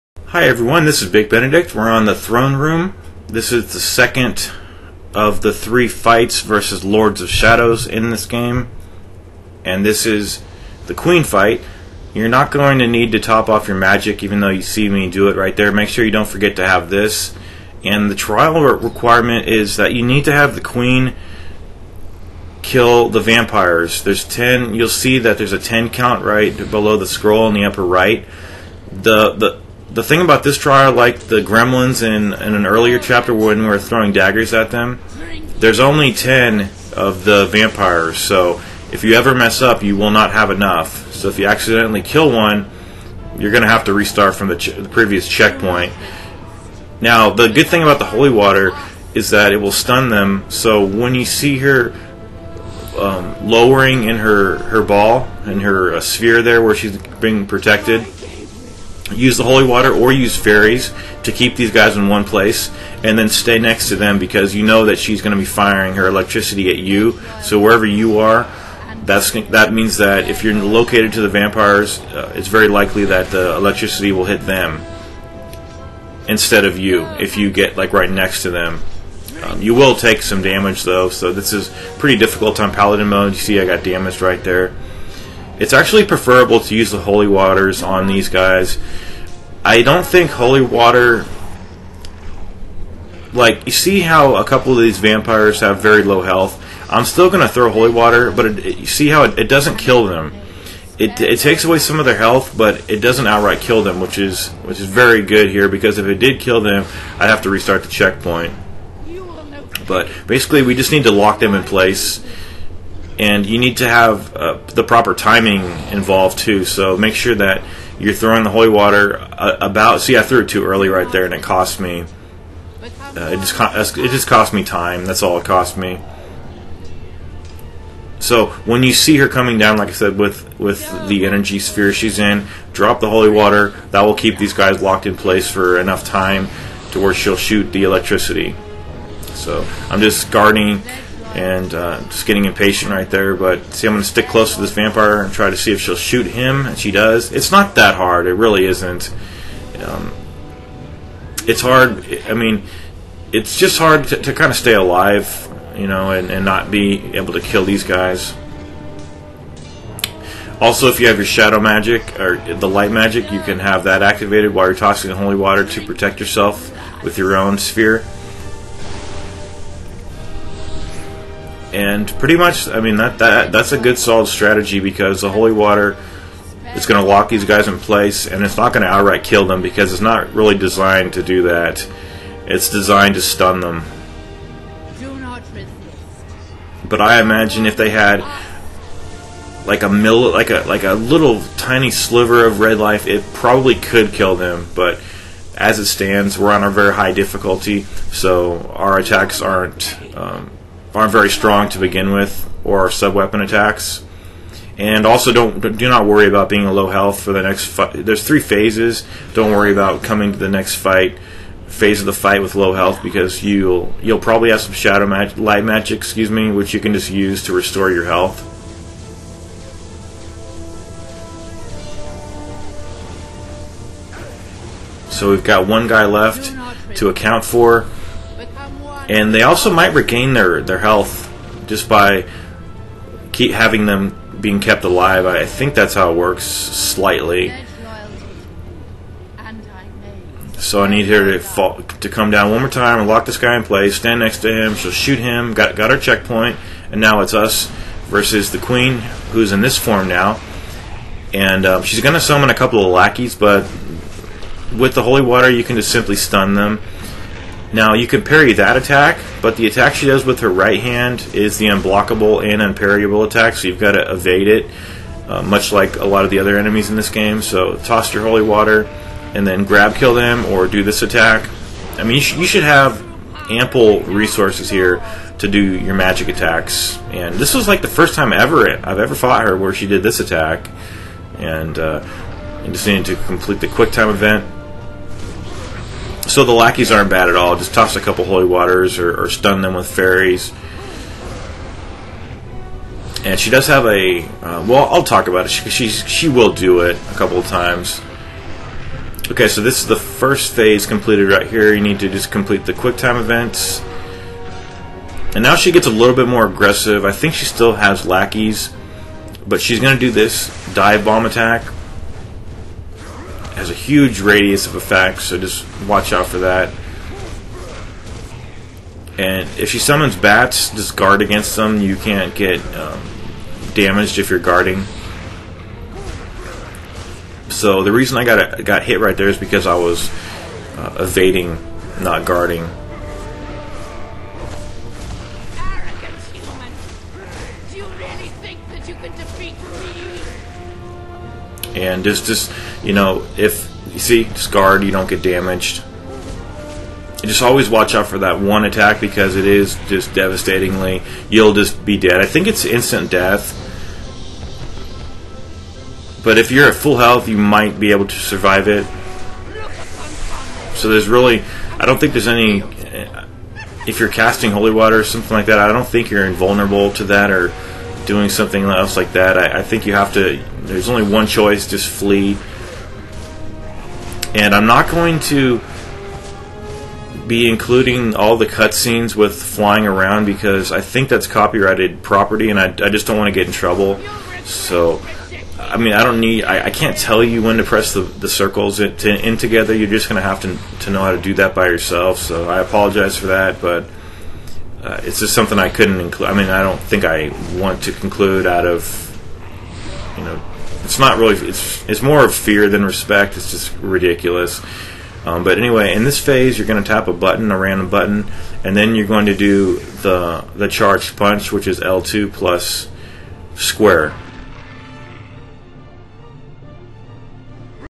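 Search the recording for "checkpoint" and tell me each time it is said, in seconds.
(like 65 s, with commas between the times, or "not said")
45 s, 107 s, 245 s.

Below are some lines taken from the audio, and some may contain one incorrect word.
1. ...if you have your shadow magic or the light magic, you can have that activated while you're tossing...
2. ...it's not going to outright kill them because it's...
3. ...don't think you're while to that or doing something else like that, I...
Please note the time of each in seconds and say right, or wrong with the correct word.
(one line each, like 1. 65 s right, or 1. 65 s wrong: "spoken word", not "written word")
1. 160 s right
2. 178 s right
3. 365 s wrong: "invulnerable", not "while".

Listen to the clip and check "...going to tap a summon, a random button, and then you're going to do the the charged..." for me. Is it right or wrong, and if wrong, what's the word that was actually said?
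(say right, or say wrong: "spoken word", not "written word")
wrong: "button", not "summon".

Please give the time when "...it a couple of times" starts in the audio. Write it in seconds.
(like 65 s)
296 s.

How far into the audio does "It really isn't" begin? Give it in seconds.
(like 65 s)
148 s.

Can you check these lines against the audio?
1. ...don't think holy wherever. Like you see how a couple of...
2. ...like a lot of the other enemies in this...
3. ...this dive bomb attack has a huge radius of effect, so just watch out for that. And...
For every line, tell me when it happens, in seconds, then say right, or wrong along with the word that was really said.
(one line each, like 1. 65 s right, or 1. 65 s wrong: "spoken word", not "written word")
1. 89 s wrong: "water", not "wherever"
2. 265 s right
3. 310 s right.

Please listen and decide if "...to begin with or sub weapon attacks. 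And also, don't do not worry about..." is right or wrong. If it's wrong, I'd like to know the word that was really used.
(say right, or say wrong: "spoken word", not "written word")
right.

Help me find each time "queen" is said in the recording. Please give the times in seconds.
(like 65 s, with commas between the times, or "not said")
10 s, 20 s, 248 s.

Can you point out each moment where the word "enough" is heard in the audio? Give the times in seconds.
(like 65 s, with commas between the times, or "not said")
40 s, 135 s.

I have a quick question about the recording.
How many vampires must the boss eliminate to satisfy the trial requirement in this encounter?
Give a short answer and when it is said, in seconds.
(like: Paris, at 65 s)
10, at 24 s.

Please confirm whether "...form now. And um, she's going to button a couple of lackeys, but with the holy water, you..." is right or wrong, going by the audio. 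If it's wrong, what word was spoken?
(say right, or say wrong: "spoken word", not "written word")
wrong: "summon", not "button".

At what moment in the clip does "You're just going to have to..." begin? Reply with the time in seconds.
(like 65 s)
389 s.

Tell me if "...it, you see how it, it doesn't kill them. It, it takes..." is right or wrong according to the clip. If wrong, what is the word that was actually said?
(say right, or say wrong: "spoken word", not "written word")
right.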